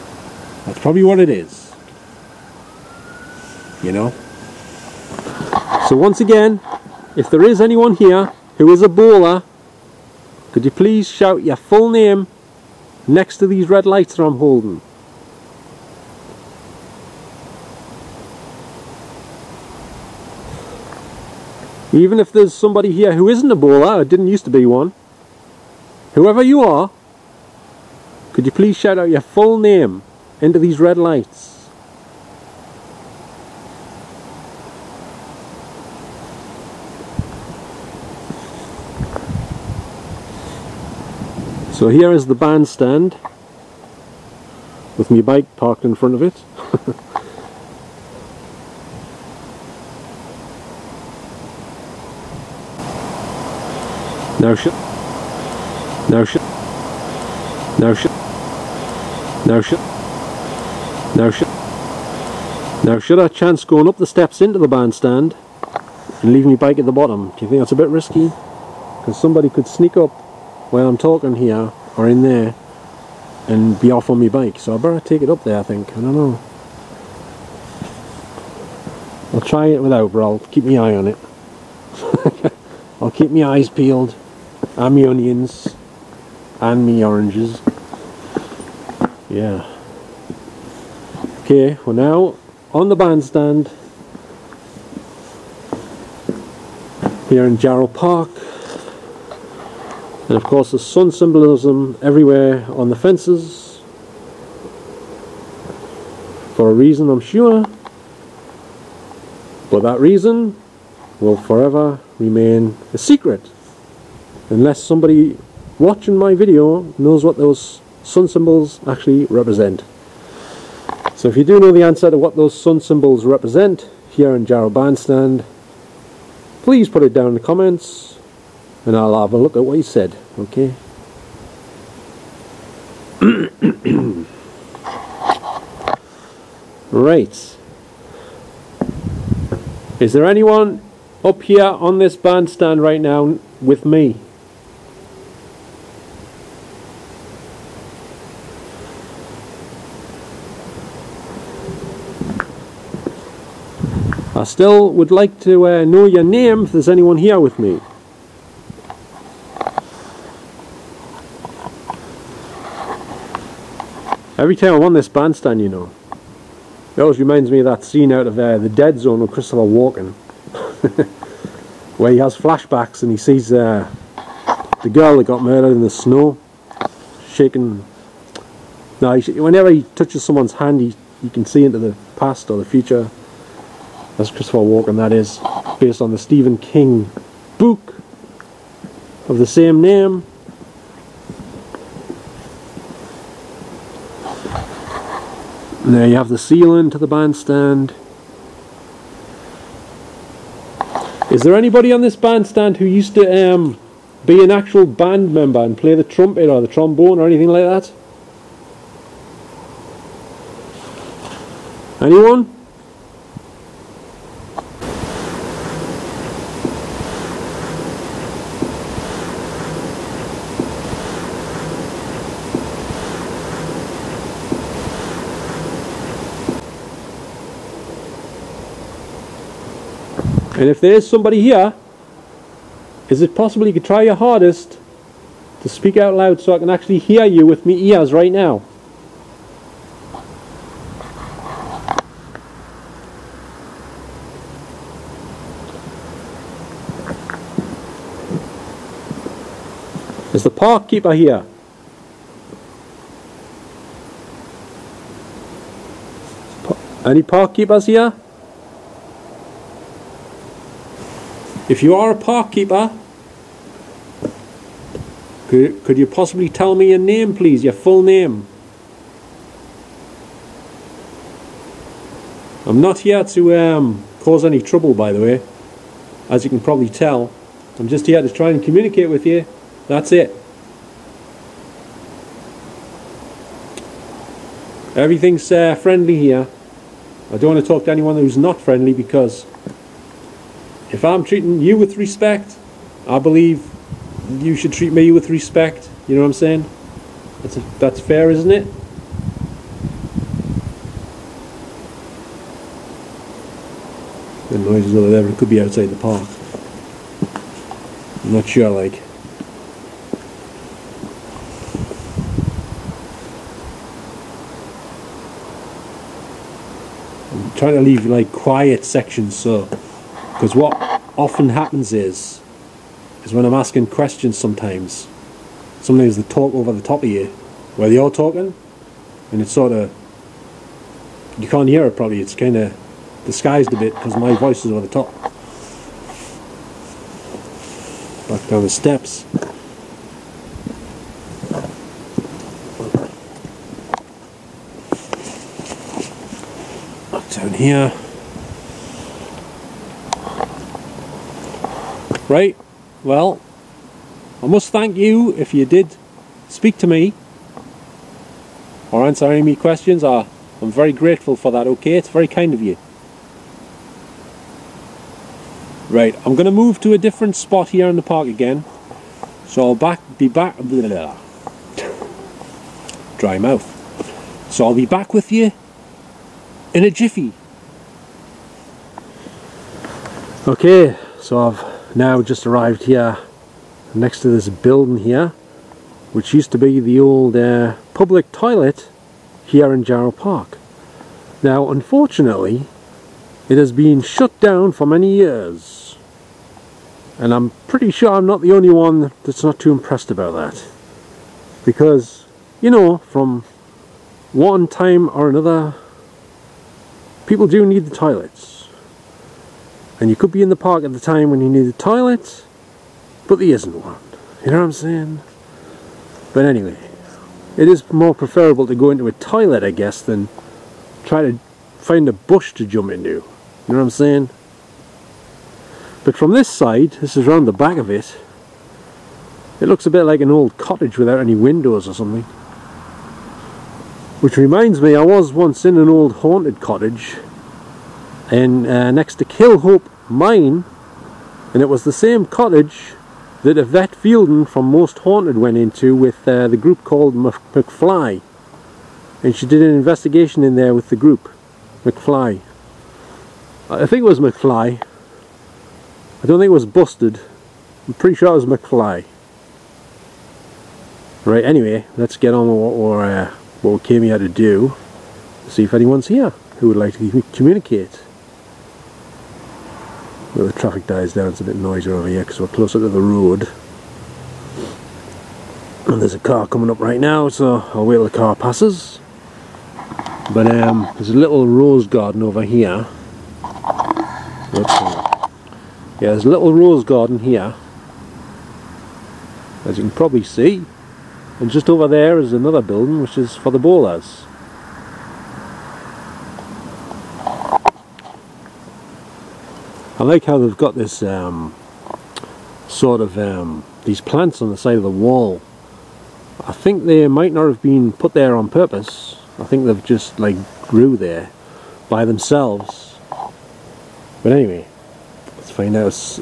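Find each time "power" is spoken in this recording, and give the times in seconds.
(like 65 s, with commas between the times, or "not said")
not said.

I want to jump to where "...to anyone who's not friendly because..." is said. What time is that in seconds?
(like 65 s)
287 s.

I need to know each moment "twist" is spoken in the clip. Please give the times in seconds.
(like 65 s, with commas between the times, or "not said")
not said.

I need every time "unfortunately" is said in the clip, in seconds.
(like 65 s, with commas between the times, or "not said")
391 s.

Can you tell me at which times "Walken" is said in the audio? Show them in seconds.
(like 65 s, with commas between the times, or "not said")
169 s, 184 s.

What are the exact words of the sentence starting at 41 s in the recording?
So here is the bandstand with my bike parked in front of it.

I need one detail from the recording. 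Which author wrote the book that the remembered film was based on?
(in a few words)
Stephen King.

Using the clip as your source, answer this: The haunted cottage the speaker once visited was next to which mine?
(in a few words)
Killhope mine.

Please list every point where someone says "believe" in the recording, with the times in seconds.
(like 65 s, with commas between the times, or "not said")
293 s.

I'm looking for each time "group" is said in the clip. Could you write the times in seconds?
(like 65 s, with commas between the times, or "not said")
446 s, 450 s.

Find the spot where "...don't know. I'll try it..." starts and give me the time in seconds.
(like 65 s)
76 s.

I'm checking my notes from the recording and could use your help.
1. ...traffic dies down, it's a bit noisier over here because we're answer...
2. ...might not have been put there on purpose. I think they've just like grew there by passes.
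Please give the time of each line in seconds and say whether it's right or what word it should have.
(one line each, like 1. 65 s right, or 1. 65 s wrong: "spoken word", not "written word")
1. 470 s wrong: "closer", not "answer"
2. 507 s wrong: "themselves", not "passes".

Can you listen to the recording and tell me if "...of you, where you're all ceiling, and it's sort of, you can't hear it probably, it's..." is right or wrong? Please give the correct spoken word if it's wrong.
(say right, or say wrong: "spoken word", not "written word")
wrong: "talking", not "ceiling".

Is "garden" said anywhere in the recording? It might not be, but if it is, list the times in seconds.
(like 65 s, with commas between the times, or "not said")
481 s, 486 s.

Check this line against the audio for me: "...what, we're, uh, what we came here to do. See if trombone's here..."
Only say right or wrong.
wrong.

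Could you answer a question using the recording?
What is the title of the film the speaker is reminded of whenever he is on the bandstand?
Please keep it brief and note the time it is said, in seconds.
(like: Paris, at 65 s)
The Dead Zone, at 168 s.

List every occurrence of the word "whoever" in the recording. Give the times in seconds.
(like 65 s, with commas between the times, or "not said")
26 s.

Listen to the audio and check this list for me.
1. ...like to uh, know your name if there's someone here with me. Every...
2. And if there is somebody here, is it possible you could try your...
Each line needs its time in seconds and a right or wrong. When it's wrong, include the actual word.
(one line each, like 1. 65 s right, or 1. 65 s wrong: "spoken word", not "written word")
1. 155 s wrong: "anyone", not "someone"
2. 230 s right.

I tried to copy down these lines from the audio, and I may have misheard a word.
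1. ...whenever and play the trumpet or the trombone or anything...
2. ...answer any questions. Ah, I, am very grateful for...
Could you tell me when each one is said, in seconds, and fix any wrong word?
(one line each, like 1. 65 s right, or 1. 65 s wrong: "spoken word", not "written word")
1. 205 s wrong: "member", not "whenever"
2. 359 s right.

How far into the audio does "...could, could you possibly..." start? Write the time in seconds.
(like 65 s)
265 s.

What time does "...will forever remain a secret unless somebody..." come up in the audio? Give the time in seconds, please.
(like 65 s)
111 s.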